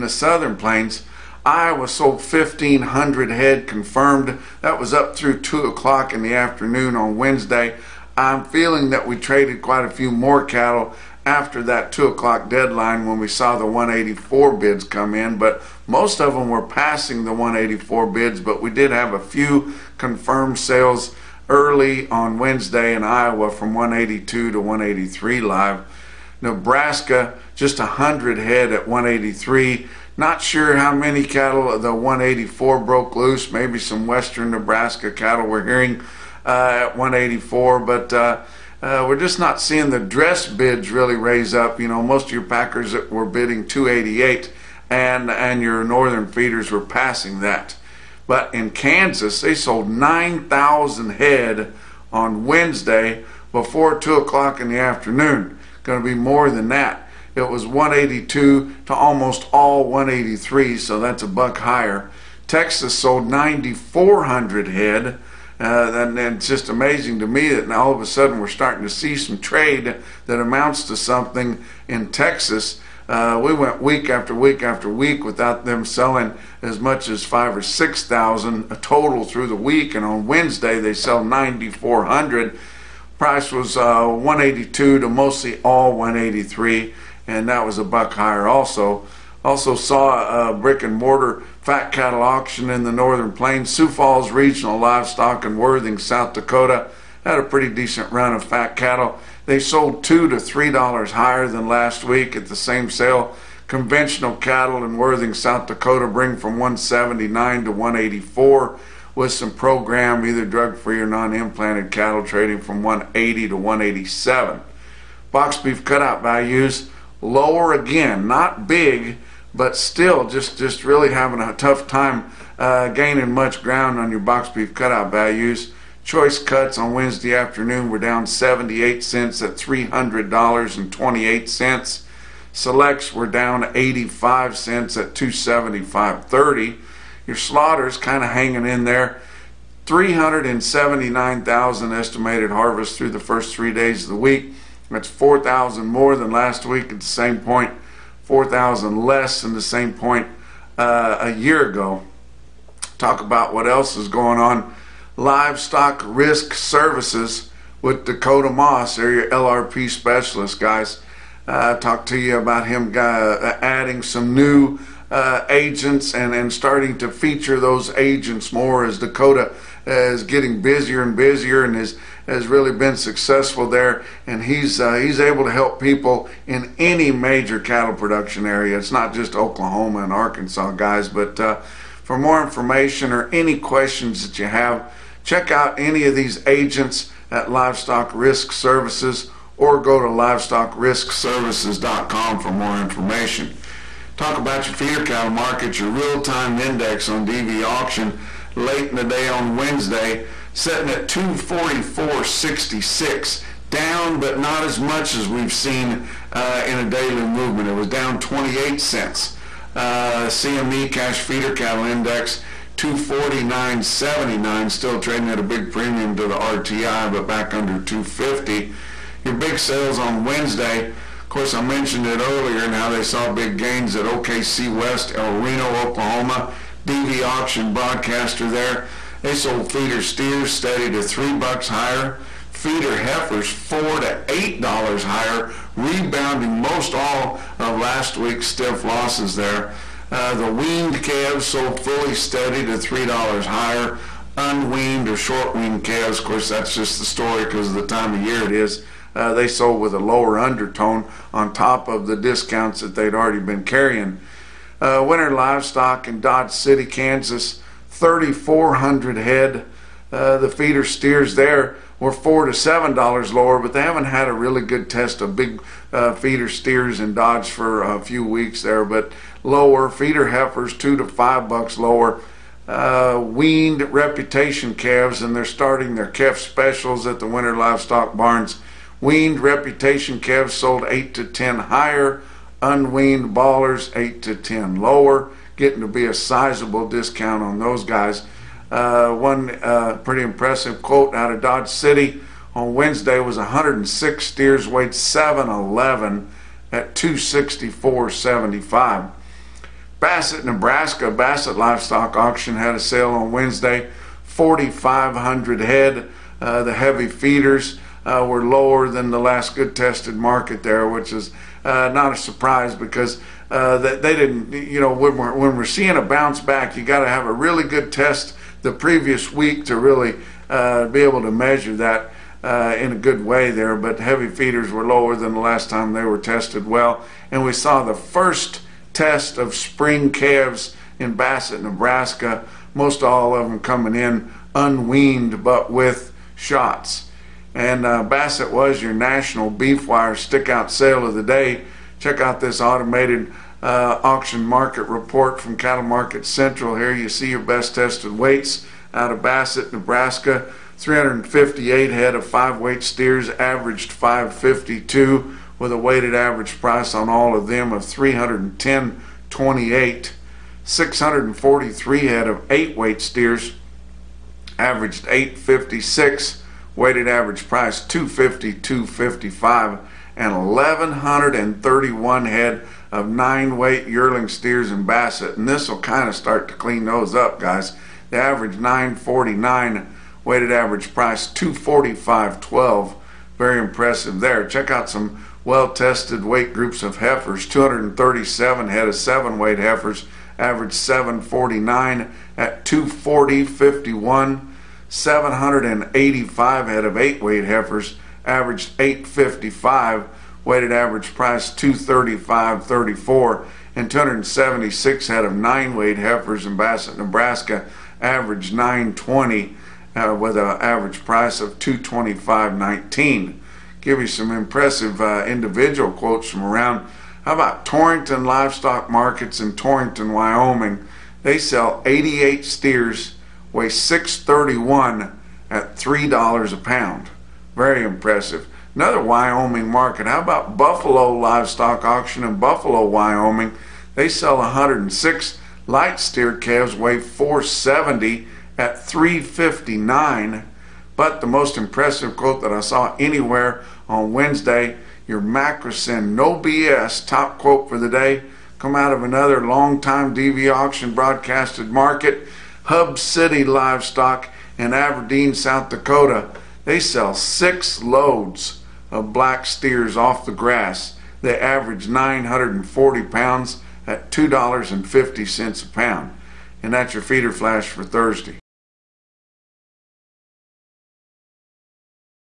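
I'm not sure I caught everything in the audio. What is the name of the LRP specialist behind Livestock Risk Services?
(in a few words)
Dakota Moss.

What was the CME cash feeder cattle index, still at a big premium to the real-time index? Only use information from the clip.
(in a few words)
249.79.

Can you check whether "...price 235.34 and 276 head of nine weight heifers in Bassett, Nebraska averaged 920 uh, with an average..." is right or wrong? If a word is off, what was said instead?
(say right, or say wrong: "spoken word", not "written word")
right.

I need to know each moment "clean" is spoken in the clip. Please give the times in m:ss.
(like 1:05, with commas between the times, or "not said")
6:16.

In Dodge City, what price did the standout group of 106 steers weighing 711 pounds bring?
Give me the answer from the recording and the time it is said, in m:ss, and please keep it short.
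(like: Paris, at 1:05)
264.75, at 4:56.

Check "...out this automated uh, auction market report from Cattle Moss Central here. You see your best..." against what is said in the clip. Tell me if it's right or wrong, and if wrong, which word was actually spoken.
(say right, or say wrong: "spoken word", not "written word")
wrong: "Market", not "Moss".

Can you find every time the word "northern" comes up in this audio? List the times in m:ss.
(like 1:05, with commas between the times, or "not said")
0:45, 1:32.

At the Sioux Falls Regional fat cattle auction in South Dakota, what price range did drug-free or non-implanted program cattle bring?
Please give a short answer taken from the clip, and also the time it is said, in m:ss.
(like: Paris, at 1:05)
180 to 187, at 1:52.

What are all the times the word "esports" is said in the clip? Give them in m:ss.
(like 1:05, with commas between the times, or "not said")
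not said.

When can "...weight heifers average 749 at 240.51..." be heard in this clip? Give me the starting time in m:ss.
6:29.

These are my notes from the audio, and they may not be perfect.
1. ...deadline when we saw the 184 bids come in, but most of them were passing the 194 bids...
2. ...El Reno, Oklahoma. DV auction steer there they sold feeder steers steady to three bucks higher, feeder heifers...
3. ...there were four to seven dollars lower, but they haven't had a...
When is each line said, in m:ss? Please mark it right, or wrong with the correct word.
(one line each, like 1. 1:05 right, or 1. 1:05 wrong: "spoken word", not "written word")
1. 0:12 wrong: "184", not "194"
2. 3:45 wrong: "broadcaster", not "steer"
3. 4:21 right.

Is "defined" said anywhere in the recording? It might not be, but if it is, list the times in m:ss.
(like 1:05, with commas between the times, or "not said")
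not said.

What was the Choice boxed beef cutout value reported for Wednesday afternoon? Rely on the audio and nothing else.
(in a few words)
$300.28.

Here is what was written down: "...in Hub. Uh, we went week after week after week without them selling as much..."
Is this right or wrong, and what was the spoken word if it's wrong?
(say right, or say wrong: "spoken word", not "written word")
wrong: "Texas", not "Hub".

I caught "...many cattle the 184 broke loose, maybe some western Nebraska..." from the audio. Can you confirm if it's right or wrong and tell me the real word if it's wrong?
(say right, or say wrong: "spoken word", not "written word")
right.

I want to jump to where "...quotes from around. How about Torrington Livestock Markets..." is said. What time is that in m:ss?
6:55.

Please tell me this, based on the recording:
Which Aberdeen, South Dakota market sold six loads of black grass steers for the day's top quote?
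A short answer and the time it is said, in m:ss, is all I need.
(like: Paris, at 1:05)
Hub City Livestock, at 7:32.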